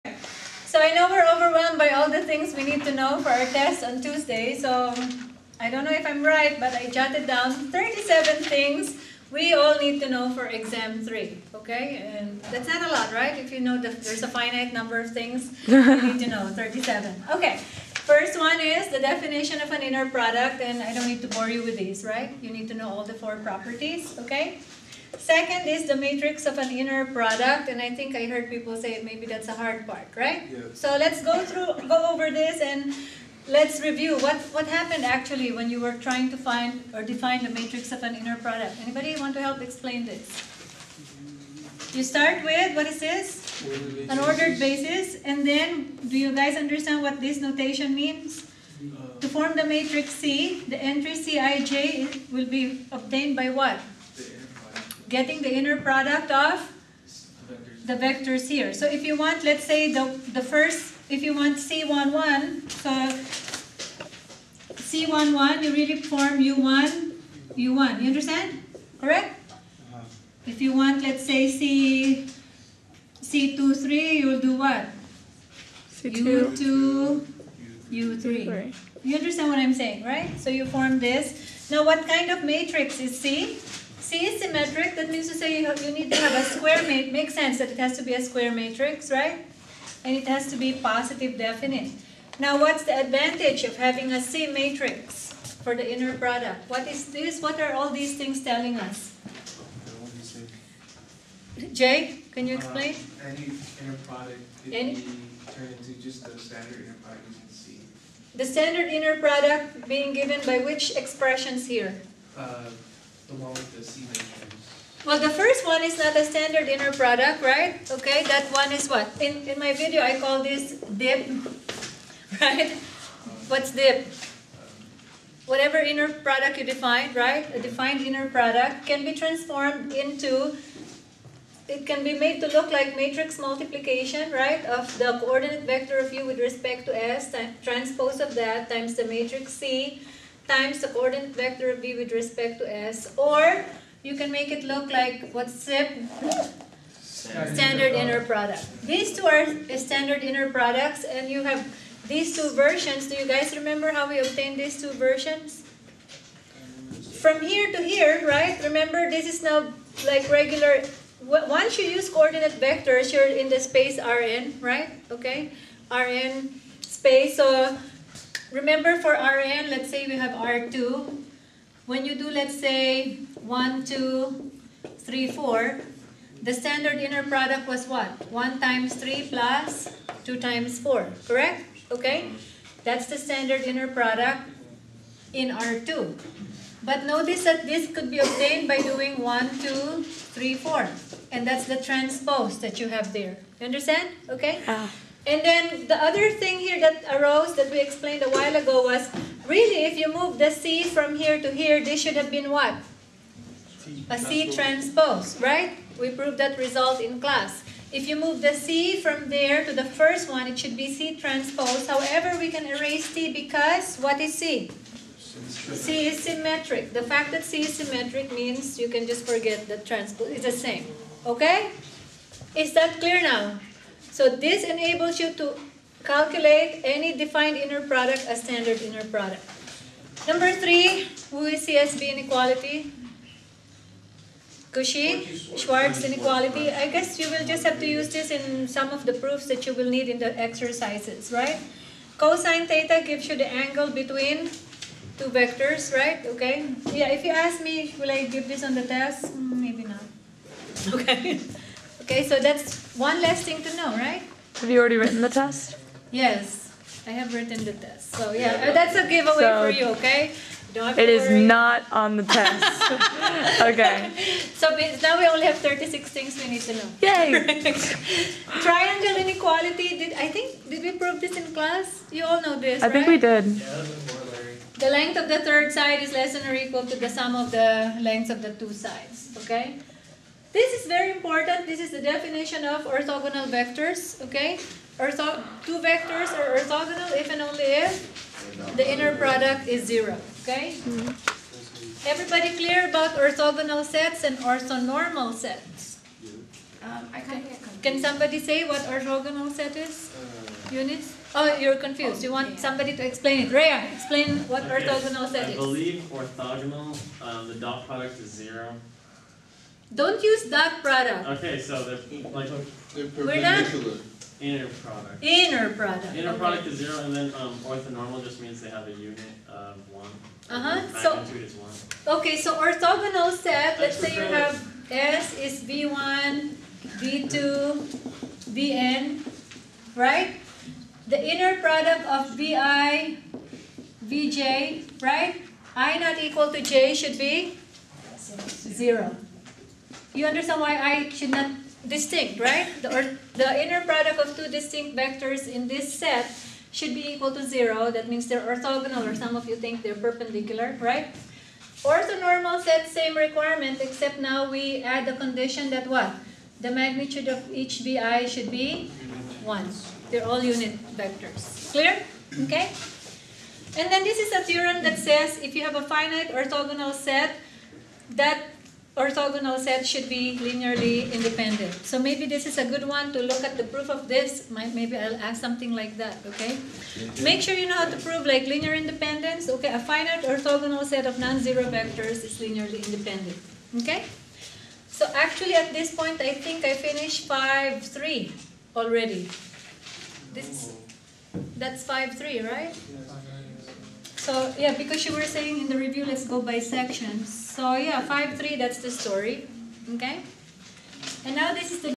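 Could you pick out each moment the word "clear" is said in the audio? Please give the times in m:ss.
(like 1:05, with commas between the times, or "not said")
3:42, 4:52, 6:01.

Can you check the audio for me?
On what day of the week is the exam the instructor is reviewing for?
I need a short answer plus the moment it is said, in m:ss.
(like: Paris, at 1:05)
Tuesday, at 0:04.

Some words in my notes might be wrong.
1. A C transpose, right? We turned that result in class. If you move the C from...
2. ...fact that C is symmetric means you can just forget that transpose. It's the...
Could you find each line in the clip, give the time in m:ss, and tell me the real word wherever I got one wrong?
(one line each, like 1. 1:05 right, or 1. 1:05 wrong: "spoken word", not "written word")
1. 3:24 wrong: "proved", not "turned"
2. 3:37 right.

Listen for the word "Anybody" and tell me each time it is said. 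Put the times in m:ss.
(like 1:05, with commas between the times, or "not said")
0:38.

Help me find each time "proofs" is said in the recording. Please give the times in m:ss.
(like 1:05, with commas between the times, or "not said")
3:59, 6:13.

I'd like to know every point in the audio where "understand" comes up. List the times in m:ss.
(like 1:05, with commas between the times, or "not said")
0:46, 1:08, 1:19, 3:13, 5:40.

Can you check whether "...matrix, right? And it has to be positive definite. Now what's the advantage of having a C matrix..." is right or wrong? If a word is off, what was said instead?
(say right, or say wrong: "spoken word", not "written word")
right.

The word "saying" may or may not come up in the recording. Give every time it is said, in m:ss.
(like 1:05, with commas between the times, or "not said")
1:19, 6:35.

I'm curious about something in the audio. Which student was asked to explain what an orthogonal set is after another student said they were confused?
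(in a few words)
Rhea.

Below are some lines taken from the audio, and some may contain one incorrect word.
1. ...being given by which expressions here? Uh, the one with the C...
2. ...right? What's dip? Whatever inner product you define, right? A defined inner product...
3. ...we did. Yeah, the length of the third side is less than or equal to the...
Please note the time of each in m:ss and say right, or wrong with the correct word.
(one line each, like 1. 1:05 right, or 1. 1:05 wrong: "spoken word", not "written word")
1. 1:49 right
2. 2:02 right
3. 4:33 right.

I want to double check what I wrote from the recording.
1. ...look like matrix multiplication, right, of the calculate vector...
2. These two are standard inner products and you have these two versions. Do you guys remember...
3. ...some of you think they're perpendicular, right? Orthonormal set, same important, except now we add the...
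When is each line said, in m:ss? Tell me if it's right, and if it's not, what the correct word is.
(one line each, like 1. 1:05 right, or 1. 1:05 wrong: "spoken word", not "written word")
1. 2:12 wrong: "coordinate", not "calculate"
2. 2:28 right
3. 5:49 wrong: "requirement", not "important".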